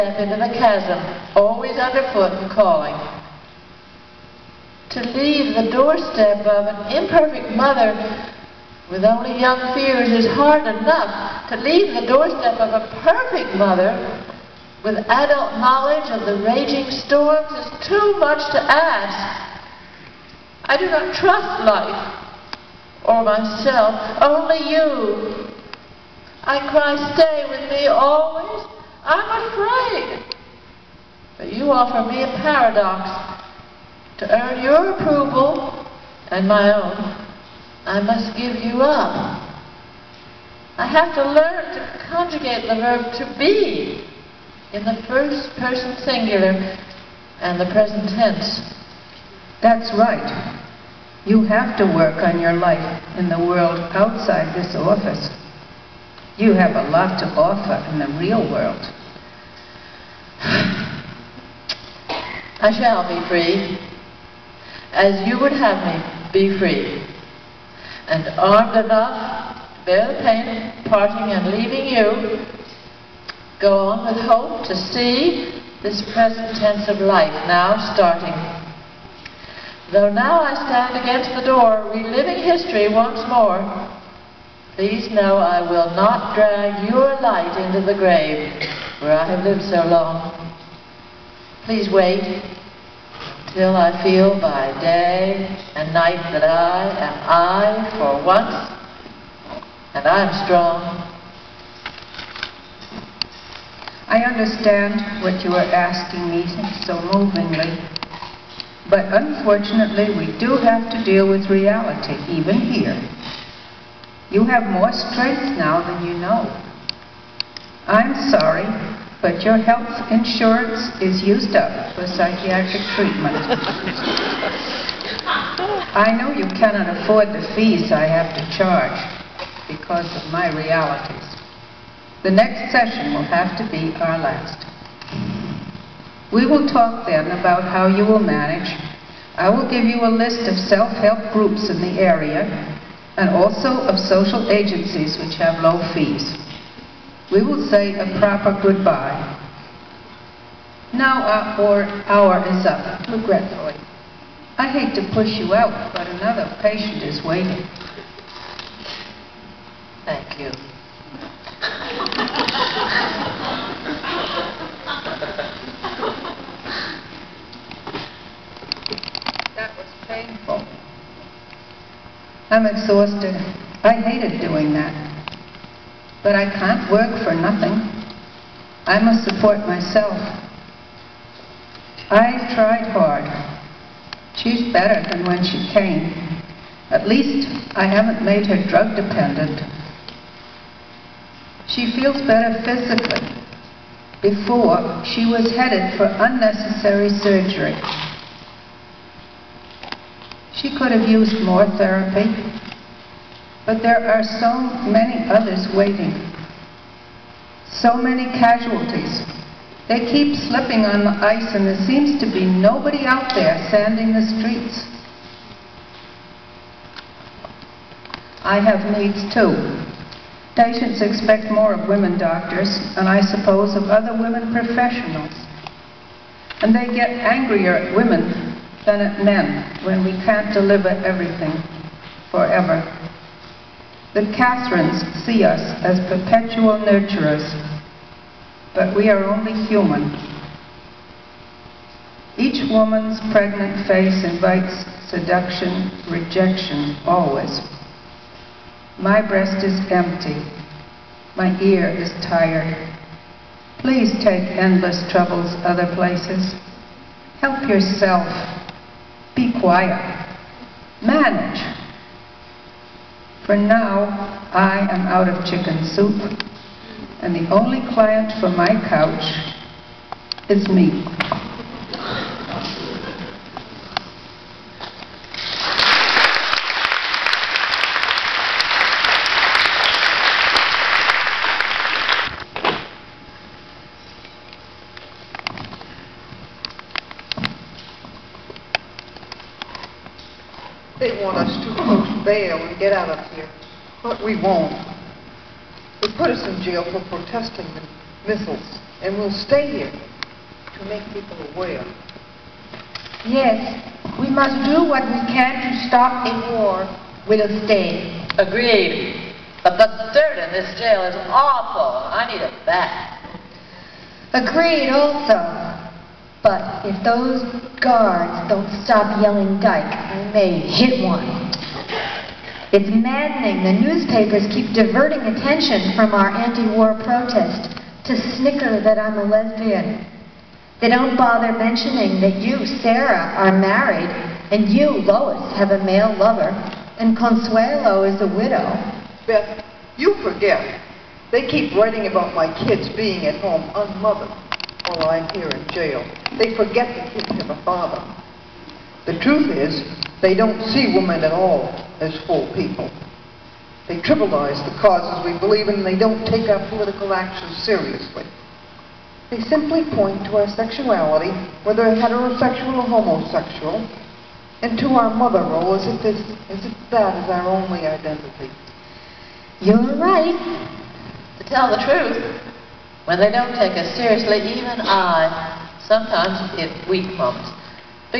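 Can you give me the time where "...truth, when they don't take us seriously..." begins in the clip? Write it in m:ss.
6:11.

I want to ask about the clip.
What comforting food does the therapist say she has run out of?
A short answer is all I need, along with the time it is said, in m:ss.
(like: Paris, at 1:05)
chicken soup, at 4:25.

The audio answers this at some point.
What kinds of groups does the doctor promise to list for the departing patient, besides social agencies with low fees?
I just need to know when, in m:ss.
2:20.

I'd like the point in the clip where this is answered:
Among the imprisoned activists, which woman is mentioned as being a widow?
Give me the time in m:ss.
5:37.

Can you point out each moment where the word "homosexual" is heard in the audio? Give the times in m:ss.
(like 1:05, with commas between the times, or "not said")
6:03.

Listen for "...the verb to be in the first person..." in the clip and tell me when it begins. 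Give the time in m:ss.
0:42.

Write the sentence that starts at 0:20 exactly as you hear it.
I do not trust life or myself, only you.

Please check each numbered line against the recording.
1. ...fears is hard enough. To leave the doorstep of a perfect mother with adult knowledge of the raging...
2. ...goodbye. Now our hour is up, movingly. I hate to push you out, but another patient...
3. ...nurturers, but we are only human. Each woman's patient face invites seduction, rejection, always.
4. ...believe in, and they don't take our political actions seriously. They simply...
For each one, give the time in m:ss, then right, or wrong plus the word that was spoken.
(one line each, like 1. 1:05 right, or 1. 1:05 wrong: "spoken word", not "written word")
1. 0:09 right
2. 2:28 wrong: "regretfully", not "movingly"
3. 3:56 wrong: "pregnant", not "patient"
4. 5:55 right.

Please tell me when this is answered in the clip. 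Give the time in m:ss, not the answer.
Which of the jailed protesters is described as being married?
5:32.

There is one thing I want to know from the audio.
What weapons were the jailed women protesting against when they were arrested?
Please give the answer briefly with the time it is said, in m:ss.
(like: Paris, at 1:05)
missiles, at 4:58.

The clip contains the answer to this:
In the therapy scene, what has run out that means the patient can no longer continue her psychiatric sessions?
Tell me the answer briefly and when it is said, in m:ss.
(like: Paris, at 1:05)
health insurance, at 1:59.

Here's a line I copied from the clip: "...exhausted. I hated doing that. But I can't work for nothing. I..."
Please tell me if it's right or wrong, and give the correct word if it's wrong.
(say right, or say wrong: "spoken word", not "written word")
right.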